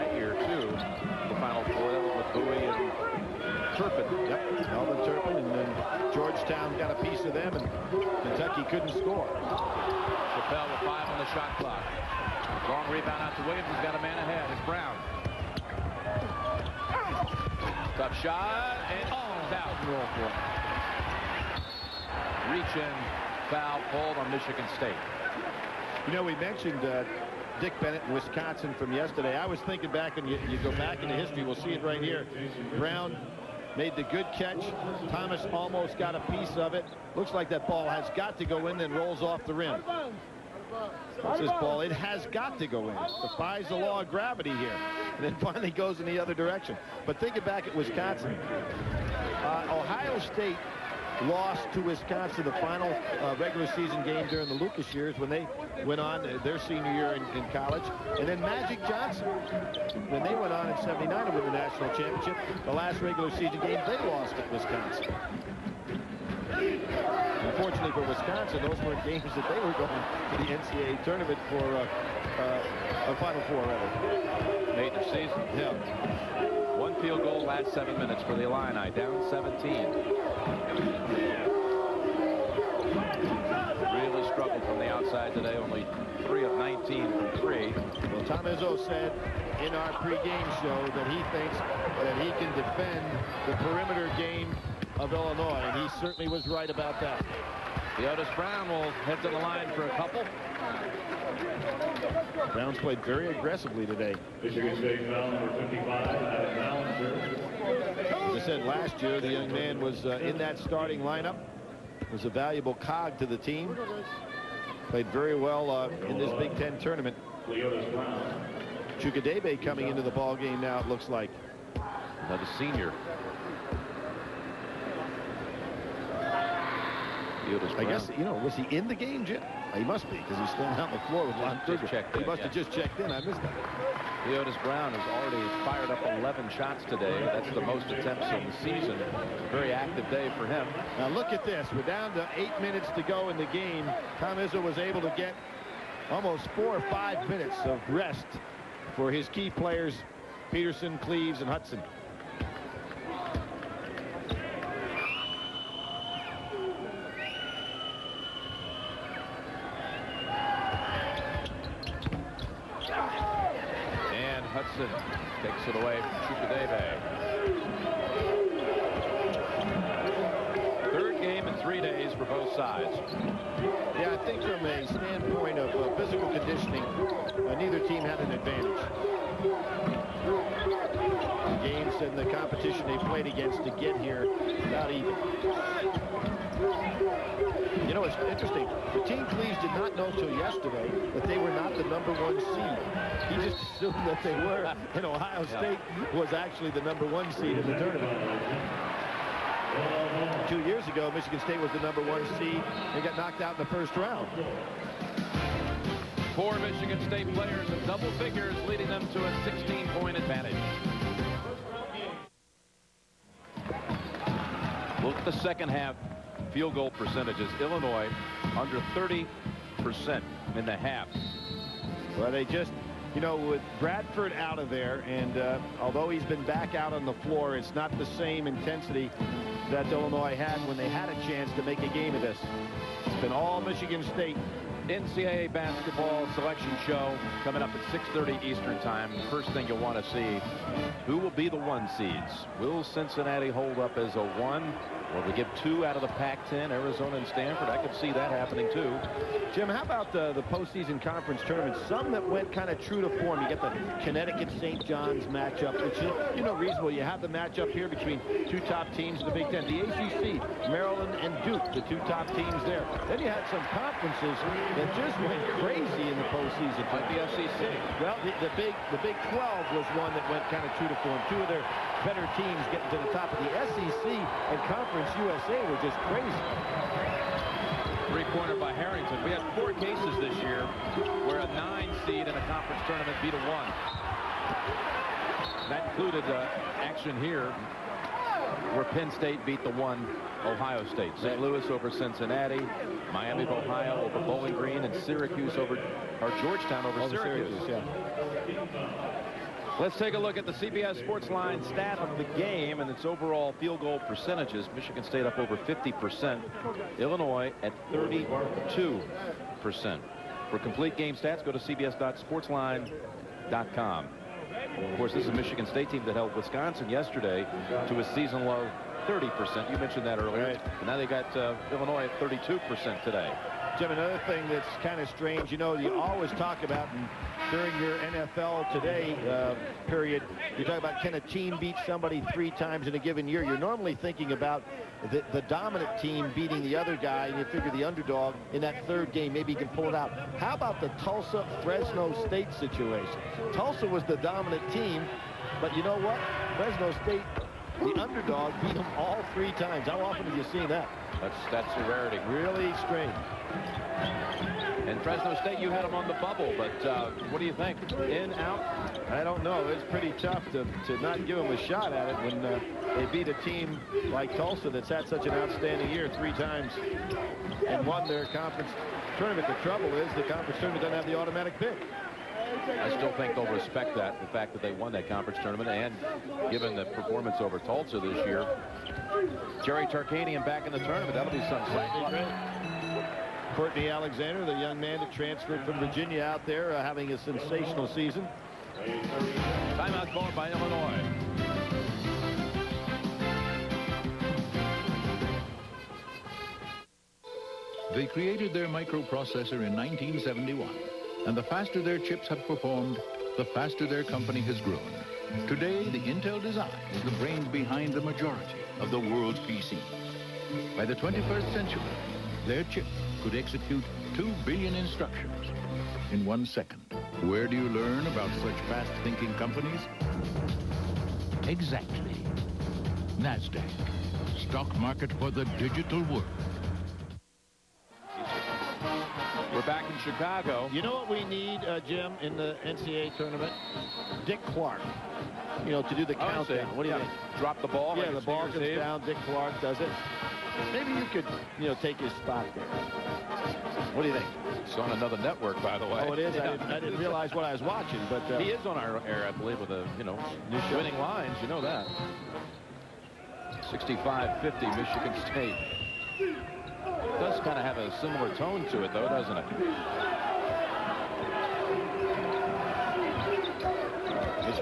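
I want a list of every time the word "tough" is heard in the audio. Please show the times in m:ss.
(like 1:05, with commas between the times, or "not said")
0:17, 6:00.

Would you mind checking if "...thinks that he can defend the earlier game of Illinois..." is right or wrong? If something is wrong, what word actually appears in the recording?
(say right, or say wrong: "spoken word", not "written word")
wrong: "perimeter", not "earlier".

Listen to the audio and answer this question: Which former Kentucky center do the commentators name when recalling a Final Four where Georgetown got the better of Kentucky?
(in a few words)
Melvin Turpin.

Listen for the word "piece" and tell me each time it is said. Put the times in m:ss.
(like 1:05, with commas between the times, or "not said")
0:07, 0:36.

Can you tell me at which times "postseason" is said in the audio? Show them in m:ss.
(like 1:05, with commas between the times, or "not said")
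4:10, 4:26.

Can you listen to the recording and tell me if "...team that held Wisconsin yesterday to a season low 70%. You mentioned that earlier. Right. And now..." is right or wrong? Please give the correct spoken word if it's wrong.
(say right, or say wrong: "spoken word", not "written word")
wrong: "30", not "70".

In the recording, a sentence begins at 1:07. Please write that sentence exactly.
Unfortunately for Wisconsin, those were games that they were going to the NCAA tournament for uh, uh, a Final Four, rather.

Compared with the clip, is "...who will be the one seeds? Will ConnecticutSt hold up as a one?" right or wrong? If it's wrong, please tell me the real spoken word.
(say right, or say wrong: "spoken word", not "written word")
wrong: "Cincinnati", not "ConnecticutSt".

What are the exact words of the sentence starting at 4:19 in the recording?
The ACC, Maryland and Duke, the two top teams there.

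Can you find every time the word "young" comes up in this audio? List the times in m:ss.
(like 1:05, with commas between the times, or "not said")
1:49, 6:24.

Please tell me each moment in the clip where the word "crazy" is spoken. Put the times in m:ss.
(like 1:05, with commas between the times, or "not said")
4:25, 4:36.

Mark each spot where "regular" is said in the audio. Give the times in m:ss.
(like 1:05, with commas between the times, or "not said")
0:53, 1:02.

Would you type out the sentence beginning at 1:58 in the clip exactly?
Chukwudebe coming into the ball game now, it looks like.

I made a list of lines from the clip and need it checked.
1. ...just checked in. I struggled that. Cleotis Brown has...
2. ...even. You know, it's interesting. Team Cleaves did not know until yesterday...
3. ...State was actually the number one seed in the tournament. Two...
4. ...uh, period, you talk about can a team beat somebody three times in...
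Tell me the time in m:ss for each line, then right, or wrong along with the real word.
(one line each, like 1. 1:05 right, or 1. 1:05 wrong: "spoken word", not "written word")
1. 2:12 wrong: "missed", not "struggled"
2. 3:04 right
3. 3:15 right
4. 5:29 right.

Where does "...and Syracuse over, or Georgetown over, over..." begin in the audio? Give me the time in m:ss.
4:54.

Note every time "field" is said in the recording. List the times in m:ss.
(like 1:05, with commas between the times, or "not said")
1:17, 3:36, 5:03.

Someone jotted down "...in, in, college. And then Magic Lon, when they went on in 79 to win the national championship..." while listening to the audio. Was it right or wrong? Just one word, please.
wrong.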